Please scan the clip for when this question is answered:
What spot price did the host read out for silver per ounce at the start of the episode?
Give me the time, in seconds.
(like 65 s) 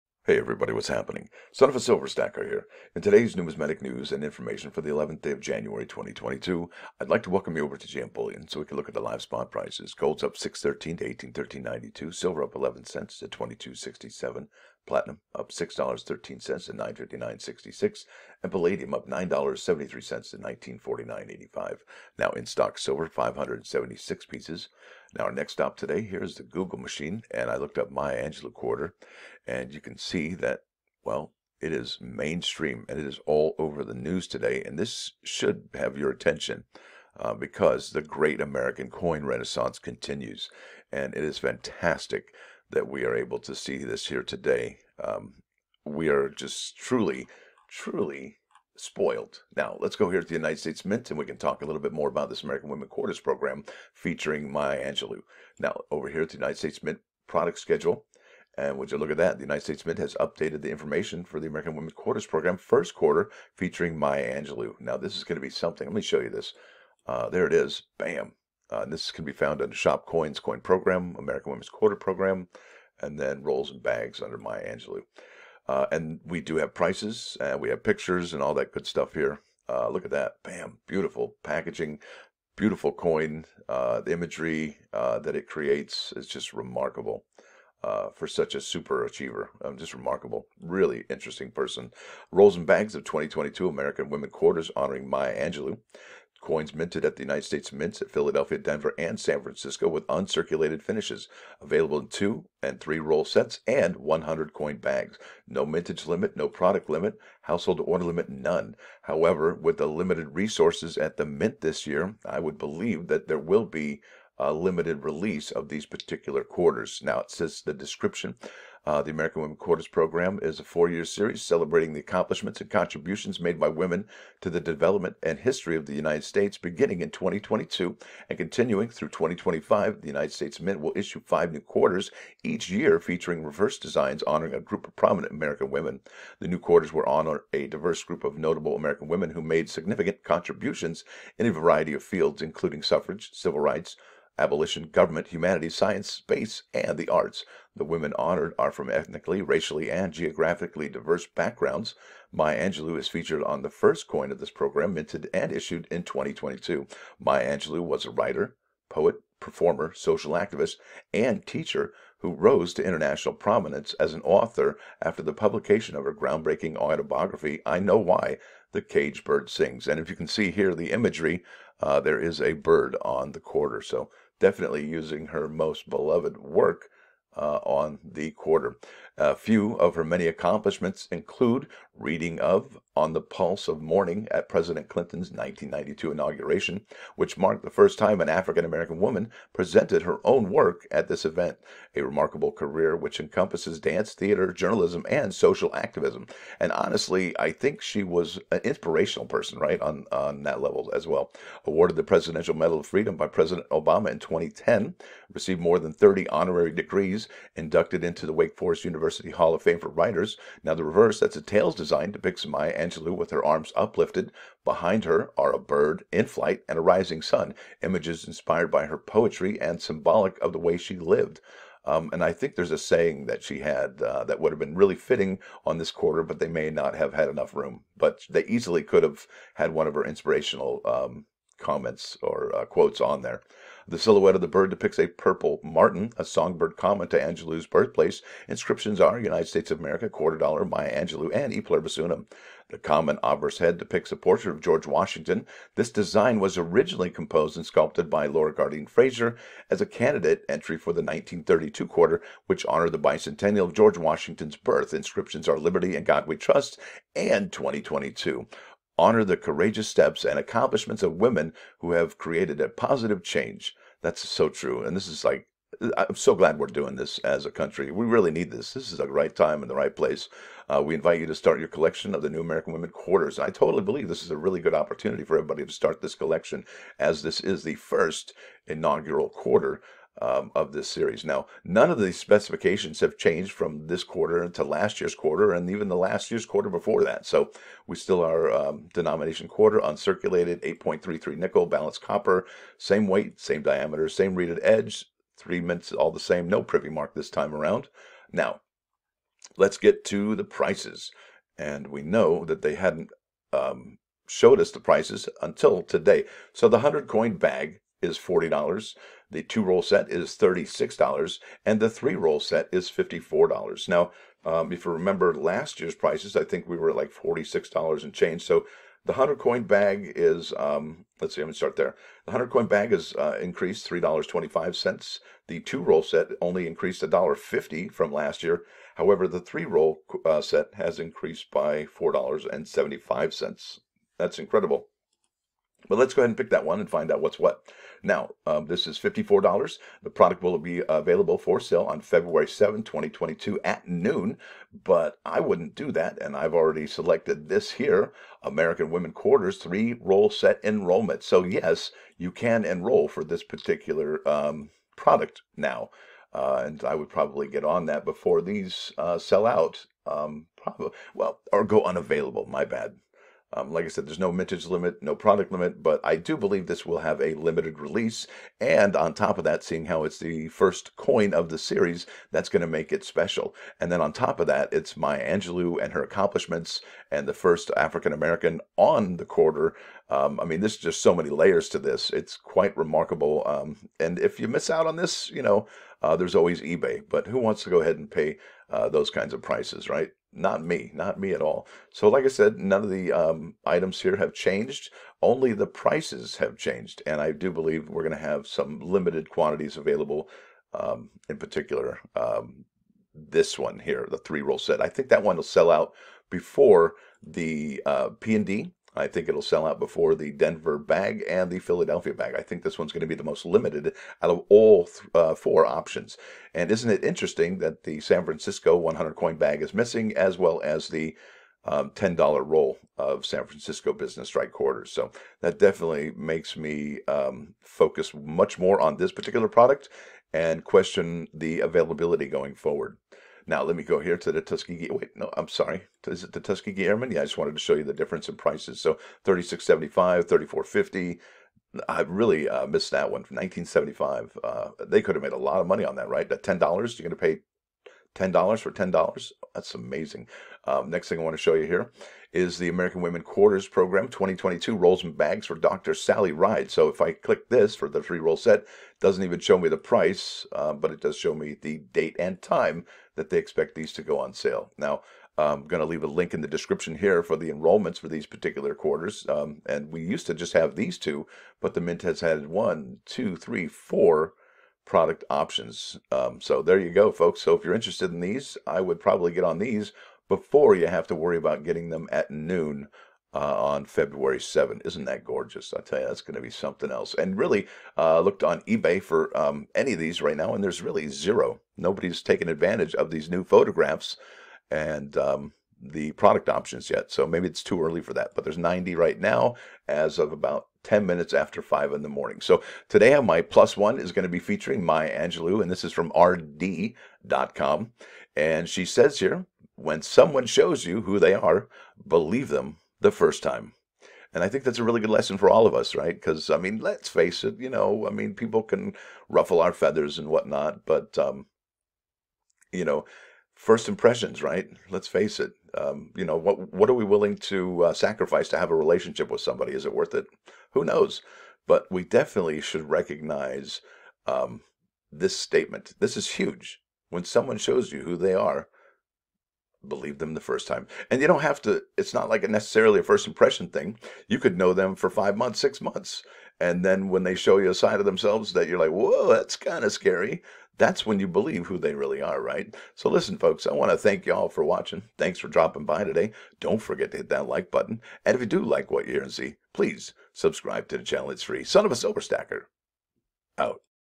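13 s.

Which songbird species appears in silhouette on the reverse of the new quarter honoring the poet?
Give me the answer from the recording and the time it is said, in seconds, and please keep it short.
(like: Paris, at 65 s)
Purple martin, at 235 s.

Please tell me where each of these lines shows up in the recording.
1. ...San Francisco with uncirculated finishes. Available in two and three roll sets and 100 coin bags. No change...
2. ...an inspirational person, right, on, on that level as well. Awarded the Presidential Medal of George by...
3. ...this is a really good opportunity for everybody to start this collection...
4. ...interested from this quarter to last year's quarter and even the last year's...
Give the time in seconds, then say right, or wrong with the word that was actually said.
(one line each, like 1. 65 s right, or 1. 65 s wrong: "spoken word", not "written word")
1. 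99 s wrong: "mintage", not "change"
2. 198 s wrong: "Freedom", not "George"
3. 274 s right
4. 283 s wrong: "changed", not "interested".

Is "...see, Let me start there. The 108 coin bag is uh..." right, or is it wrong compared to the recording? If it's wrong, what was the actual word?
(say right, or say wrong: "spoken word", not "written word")
wrong: "100", not "108".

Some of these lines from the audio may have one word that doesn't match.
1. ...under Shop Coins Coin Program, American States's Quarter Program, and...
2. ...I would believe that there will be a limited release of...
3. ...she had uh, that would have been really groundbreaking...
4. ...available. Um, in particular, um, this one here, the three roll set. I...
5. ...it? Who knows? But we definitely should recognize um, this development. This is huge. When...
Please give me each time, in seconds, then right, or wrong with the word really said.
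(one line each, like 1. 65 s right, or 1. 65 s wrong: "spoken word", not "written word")
1. 69 s wrong: "Women", not "States"
2. 112 s right
3. 223 s wrong: "fitting", not "groundbreaking"
4. 399 s right
5. 530 s wrong: "statement", not "development".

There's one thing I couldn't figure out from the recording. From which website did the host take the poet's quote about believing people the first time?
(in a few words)
rd.com.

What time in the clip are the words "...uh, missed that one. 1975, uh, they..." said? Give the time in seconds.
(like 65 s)
442 s.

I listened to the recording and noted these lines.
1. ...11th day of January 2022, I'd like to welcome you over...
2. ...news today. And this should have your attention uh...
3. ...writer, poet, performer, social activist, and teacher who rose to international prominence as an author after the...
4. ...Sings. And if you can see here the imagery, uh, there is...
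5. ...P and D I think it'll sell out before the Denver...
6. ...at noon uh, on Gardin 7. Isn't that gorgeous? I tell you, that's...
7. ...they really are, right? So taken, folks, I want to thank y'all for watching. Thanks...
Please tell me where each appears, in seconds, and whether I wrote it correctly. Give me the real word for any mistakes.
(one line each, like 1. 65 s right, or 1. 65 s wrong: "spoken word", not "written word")
1. 4 s right
2. 33 s right
3. 158 s right
4. 169 s right
5. 408 s right
6. 482 s wrong: "February", not "Gardin"
7. 551 s wrong: "listen", not "taken".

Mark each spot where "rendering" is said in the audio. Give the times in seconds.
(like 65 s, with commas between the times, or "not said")
not said.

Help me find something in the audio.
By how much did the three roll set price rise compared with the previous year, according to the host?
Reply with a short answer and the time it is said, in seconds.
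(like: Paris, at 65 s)
$4.75, at 331 s.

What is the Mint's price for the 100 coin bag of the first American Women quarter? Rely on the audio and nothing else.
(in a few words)
$40.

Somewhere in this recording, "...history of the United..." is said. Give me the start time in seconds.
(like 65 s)
125 s.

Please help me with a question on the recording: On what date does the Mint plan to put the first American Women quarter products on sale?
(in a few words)
February 7, 2022.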